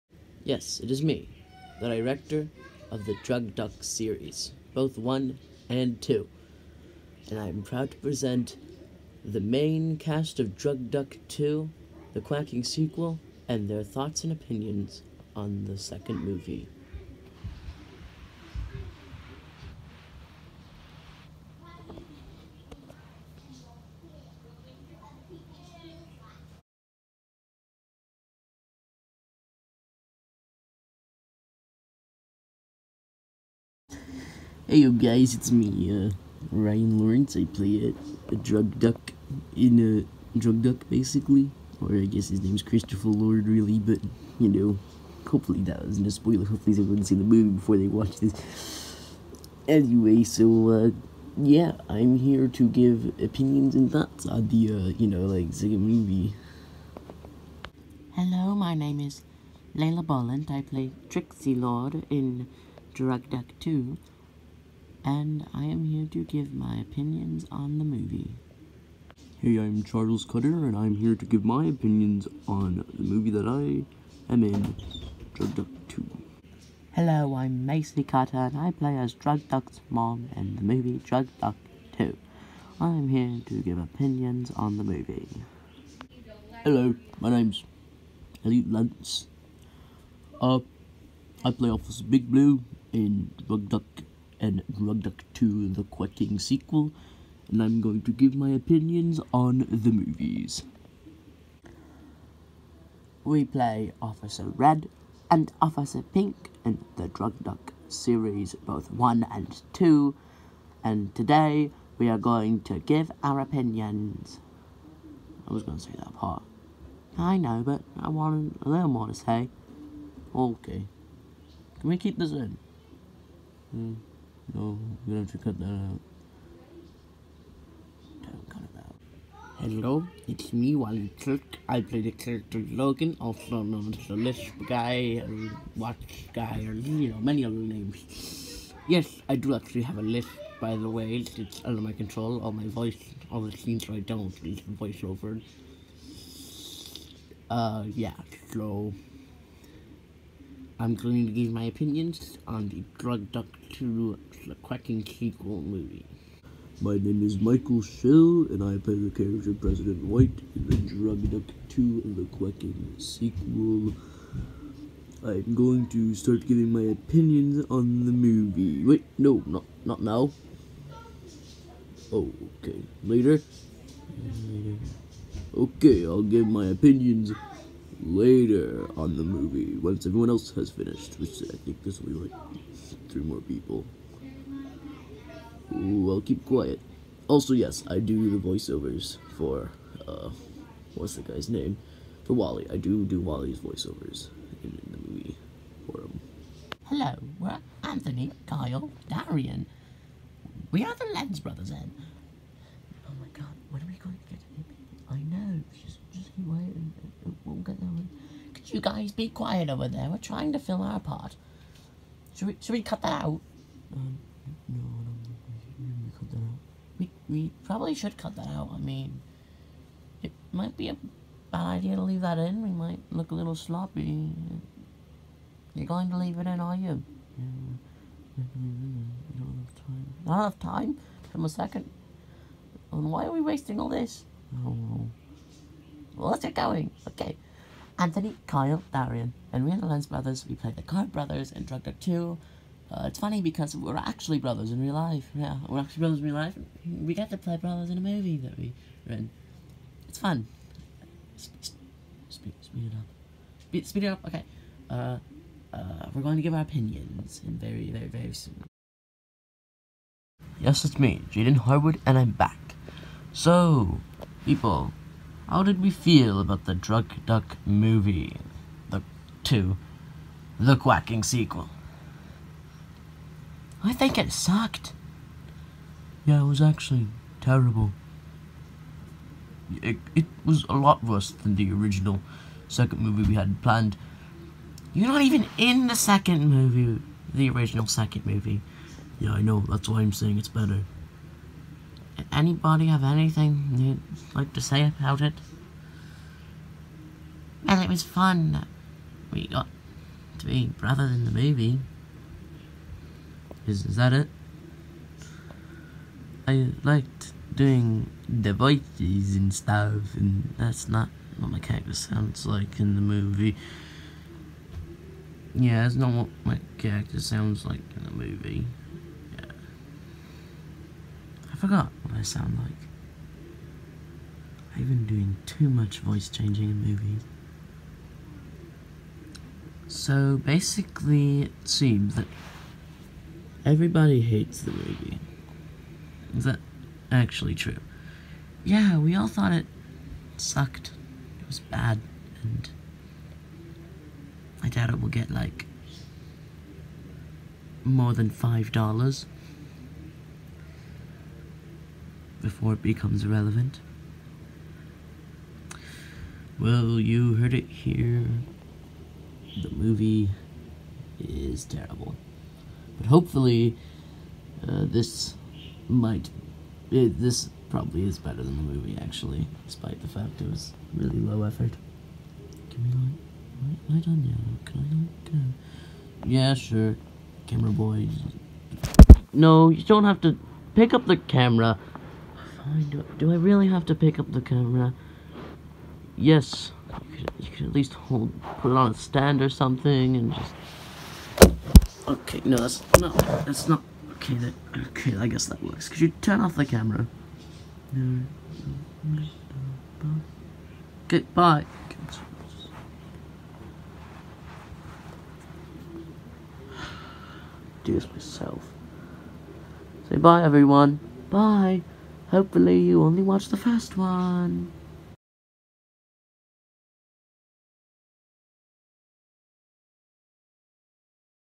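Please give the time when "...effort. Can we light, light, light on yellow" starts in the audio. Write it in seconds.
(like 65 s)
371 s.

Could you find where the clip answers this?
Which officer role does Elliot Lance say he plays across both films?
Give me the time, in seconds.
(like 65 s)
91 s.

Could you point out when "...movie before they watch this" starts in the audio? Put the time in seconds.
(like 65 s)
47 s.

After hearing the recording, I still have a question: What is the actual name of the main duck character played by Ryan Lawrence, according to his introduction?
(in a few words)
Christopher Lord.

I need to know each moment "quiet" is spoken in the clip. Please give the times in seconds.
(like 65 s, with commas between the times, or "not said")
186 s, 209 s.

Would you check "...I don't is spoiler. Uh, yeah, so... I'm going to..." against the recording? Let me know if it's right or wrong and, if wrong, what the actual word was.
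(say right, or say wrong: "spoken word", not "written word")
wrong: "voiceover", not "spoiler".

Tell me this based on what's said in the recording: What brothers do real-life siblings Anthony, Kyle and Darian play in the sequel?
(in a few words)
Card Brothers.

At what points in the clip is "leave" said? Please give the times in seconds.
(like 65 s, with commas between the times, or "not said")
222 s, 226 s.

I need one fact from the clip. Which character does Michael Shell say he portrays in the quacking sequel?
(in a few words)
President White.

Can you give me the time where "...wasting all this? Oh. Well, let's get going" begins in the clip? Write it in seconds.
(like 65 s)
233 s.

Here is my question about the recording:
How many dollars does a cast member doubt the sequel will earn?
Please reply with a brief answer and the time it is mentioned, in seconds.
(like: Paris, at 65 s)
5, at 348 s.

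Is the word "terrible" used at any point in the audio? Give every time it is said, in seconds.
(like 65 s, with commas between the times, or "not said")
277 s, 361 s.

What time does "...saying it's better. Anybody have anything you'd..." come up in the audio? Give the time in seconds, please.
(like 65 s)
290 s.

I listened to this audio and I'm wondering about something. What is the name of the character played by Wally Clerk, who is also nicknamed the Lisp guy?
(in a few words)
Logan.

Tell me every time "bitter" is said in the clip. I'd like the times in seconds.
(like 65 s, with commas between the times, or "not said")
not said.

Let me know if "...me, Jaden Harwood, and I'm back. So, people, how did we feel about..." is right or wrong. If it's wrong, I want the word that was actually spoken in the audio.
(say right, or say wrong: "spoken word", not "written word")
right.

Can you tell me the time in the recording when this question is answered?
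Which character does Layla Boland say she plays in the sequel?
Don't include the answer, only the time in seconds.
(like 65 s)
61 s.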